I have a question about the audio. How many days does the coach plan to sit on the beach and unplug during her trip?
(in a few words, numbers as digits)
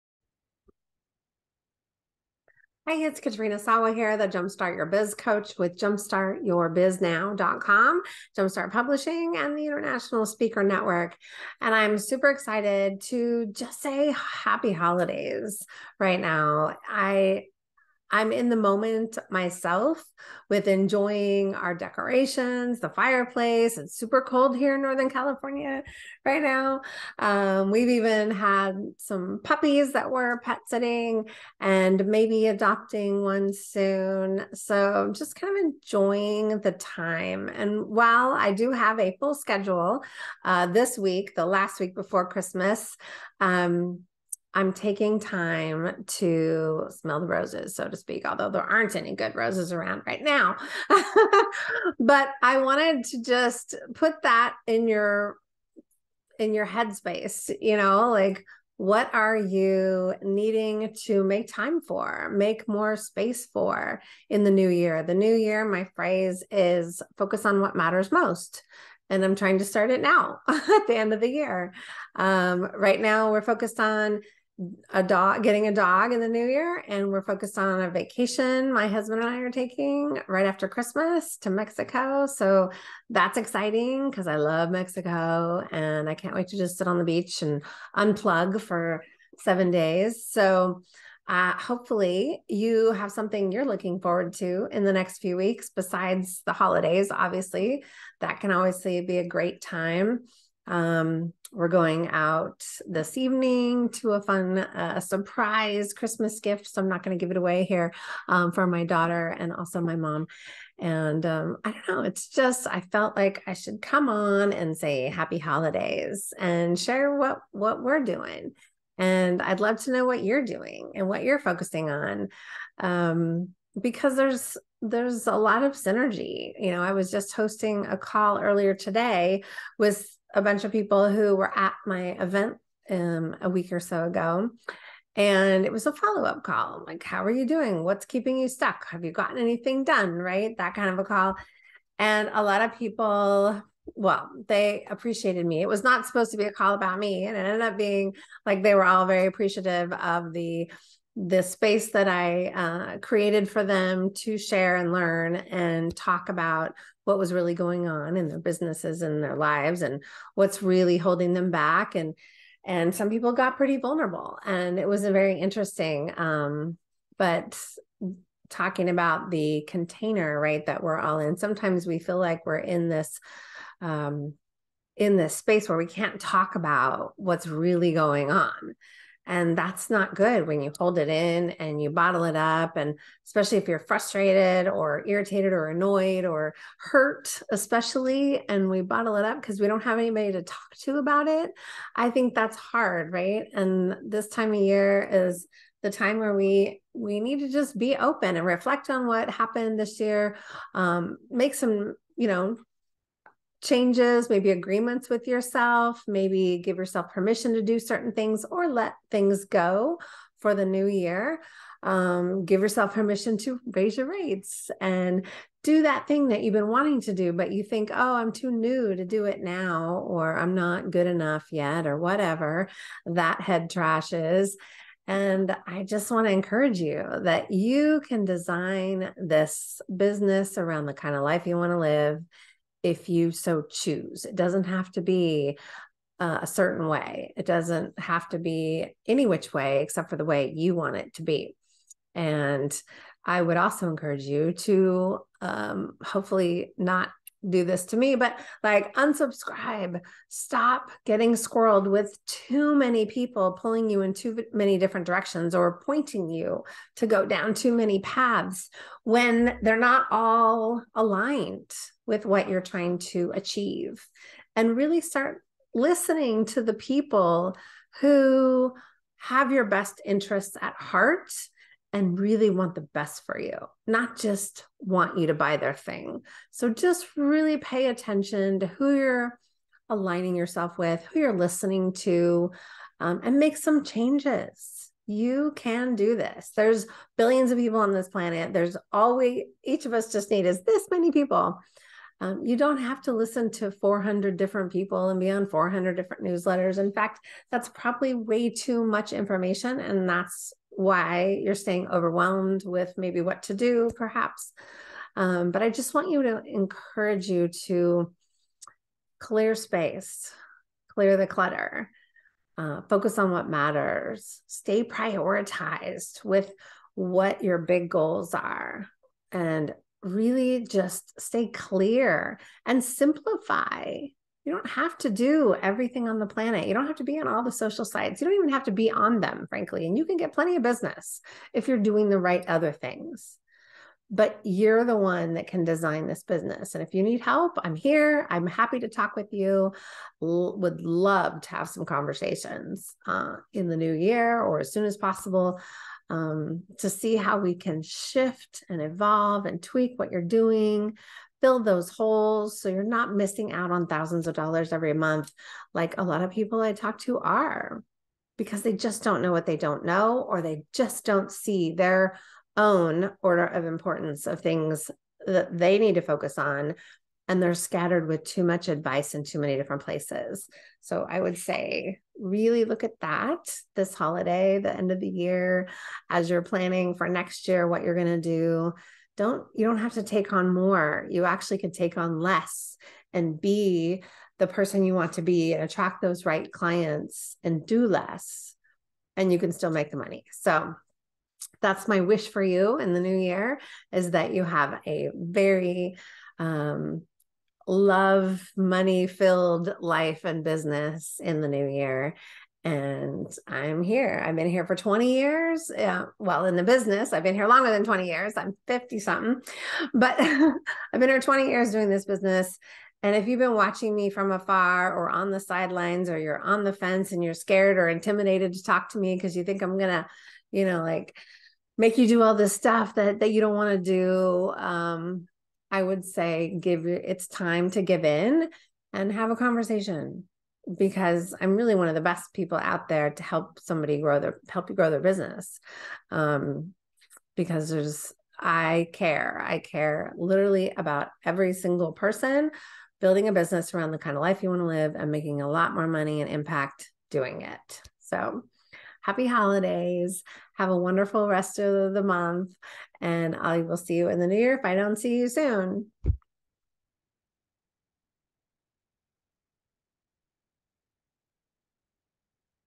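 7.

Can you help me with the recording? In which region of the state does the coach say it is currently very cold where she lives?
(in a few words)
Northern California.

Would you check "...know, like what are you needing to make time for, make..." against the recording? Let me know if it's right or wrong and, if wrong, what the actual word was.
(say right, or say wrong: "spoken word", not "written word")
right.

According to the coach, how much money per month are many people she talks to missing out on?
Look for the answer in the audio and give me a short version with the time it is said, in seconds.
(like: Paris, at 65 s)
Thousands of dollars, at 353 s.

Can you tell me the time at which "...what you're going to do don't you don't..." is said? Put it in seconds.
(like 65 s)
377 s.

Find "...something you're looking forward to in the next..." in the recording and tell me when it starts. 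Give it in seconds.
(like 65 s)
93 s.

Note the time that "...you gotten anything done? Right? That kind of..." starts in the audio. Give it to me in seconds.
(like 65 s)
139 s.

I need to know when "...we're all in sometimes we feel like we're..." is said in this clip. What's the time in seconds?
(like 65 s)
170 s.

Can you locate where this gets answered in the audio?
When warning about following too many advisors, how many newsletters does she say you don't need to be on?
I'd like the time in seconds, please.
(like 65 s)
295 s.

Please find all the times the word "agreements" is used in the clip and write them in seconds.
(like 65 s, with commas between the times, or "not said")
204 s.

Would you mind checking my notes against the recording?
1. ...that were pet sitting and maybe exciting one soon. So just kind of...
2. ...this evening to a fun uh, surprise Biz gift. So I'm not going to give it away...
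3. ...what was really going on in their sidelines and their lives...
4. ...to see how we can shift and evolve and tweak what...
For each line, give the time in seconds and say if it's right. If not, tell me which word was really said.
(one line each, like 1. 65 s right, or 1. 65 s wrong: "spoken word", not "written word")
1. 29 s wrong: "adopting", not "exciting"
2. 102 s wrong: "Christmas", not "Biz"
3. 157 s wrong: "businesses", not "sidelines"
4. 346 s right.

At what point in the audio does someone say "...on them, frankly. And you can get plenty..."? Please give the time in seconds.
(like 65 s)
328 s.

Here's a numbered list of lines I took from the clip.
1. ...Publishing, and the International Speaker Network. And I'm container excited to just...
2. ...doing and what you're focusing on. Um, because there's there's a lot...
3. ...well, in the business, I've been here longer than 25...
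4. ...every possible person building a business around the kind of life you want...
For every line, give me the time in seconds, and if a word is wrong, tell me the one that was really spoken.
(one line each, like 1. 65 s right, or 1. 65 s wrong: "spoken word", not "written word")
1. 8 s wrong: "super", not "container"
2. 120 s right
3. 406 s wrong: "20", not "25"
4. 441 s wrong: "single", not "possible".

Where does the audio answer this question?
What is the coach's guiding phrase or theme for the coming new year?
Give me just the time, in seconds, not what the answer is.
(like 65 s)
67 s.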